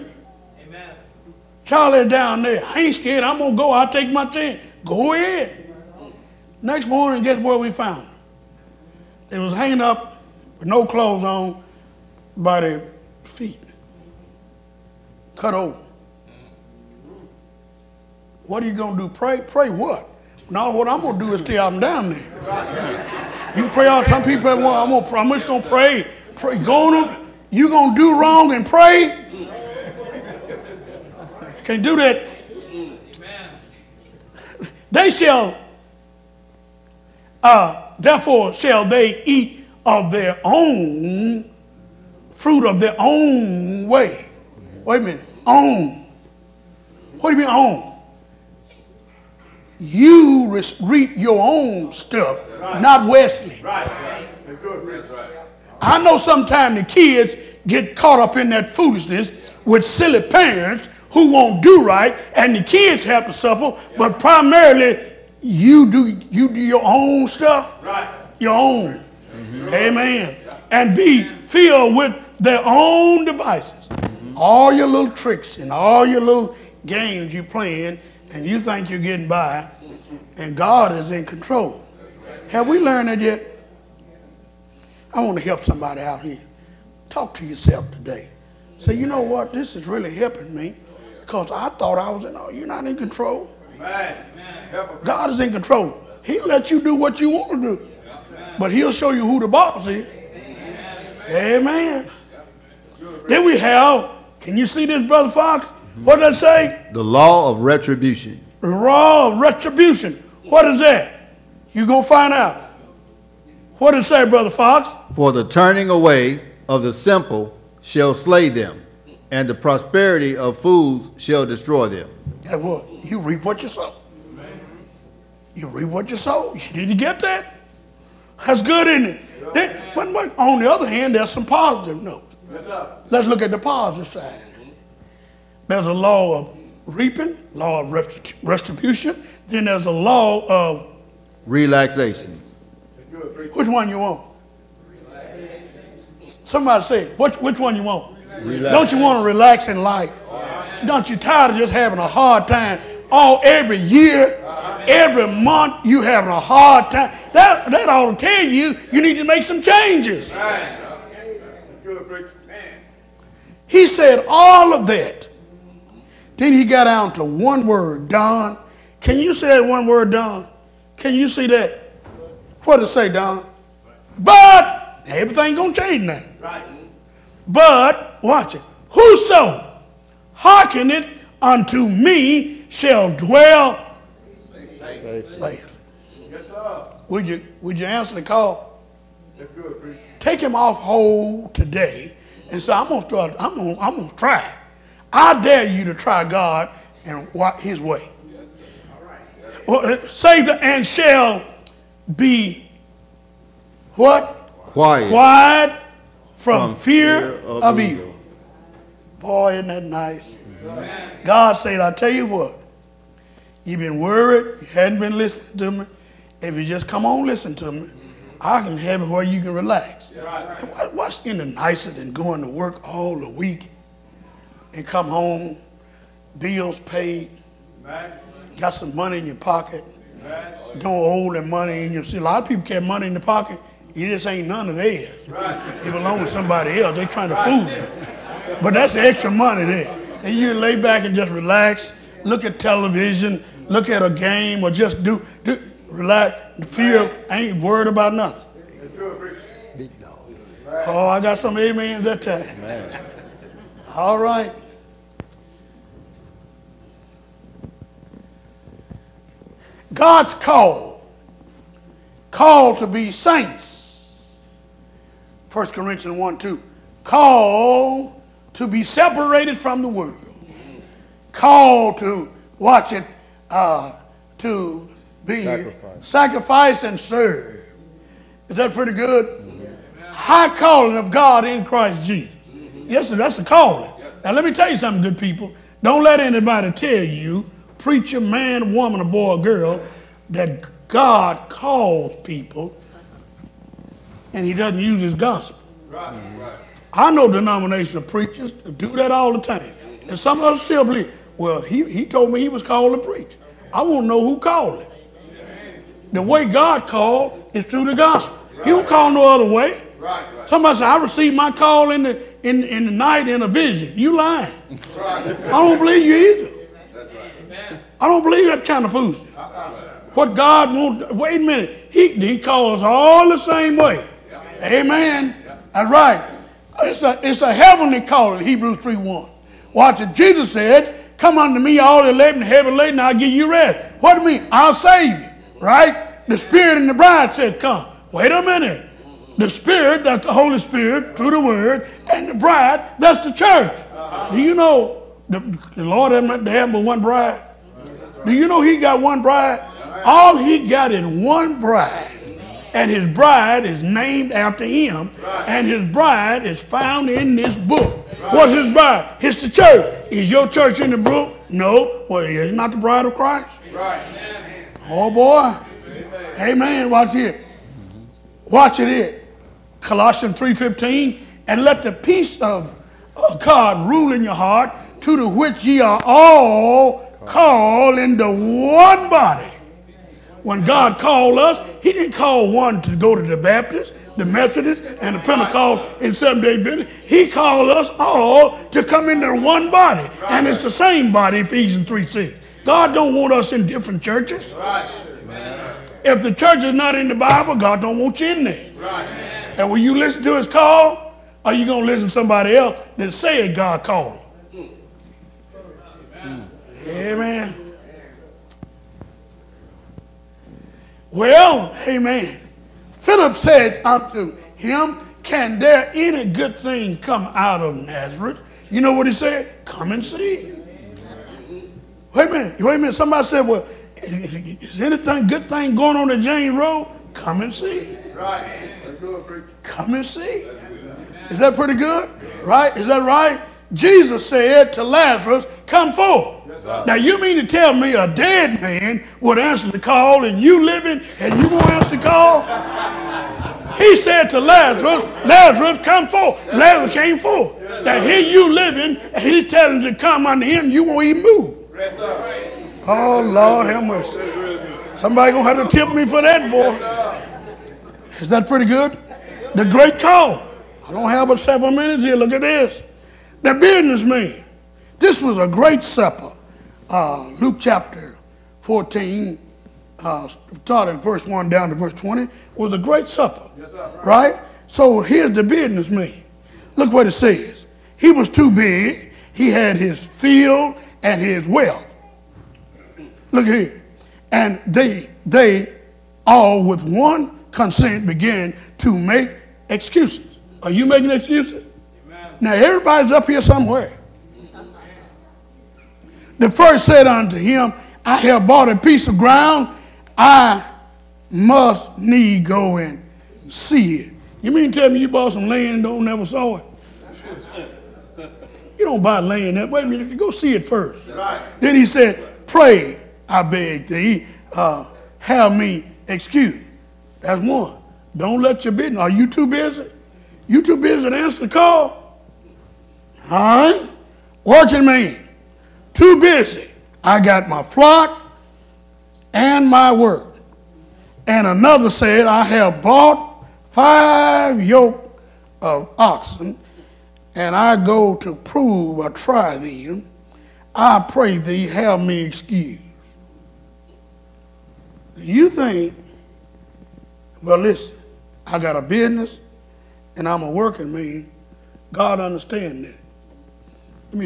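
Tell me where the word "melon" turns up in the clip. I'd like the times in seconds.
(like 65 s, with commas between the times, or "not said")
not said.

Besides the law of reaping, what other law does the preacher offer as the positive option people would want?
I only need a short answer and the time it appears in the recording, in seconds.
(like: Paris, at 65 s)
Law of relaxation, at 139 s.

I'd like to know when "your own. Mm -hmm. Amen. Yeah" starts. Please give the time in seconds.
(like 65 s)
68 s.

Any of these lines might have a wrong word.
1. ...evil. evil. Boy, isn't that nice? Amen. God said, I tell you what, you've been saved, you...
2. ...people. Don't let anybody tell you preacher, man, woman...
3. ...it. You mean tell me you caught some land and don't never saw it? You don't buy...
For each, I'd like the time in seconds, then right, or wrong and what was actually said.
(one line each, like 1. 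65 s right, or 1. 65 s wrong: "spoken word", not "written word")
1. 207 s wrong: "worried", not "saved"
2. 285 s right
3. 503 s wrong: "bought", not "caught".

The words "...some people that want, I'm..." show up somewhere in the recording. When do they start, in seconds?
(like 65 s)
24 s.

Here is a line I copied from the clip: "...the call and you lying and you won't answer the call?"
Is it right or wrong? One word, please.
wrong.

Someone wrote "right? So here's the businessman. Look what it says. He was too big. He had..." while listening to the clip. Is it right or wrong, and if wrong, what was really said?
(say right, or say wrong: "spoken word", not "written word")
right.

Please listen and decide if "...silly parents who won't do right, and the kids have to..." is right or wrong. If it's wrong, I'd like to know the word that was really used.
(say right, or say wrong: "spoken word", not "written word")
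right.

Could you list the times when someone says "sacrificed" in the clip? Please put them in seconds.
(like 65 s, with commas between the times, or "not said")
276 s.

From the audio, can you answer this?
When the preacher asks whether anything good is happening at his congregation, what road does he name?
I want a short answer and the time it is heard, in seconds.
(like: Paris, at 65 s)
James Road, at 426 s.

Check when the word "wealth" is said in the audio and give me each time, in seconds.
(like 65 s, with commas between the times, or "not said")
481 s.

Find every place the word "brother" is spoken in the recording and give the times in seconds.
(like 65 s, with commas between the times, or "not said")
105 s, 114 s.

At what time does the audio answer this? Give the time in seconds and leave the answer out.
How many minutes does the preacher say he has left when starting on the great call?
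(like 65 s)
461 s.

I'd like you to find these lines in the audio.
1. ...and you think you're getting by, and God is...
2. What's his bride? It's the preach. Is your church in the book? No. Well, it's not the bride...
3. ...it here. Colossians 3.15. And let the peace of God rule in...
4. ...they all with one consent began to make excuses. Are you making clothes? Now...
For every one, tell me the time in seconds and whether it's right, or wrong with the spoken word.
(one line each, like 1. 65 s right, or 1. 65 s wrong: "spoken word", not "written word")
1. 78 s right
2. 358 s wrong: "church", not "preach"
3. 368 s right
4. 485 s wrong: "excuses", not "clothes".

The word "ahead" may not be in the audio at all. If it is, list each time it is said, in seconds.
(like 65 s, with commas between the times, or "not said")
5 s.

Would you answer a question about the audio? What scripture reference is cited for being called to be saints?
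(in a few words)
1 Corinthians 1:2.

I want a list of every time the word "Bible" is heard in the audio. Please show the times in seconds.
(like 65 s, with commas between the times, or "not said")
397 s.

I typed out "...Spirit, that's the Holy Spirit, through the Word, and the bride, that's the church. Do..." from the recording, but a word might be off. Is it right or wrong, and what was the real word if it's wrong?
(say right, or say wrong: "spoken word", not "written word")
right.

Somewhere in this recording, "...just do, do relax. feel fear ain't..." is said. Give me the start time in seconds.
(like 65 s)
244 s.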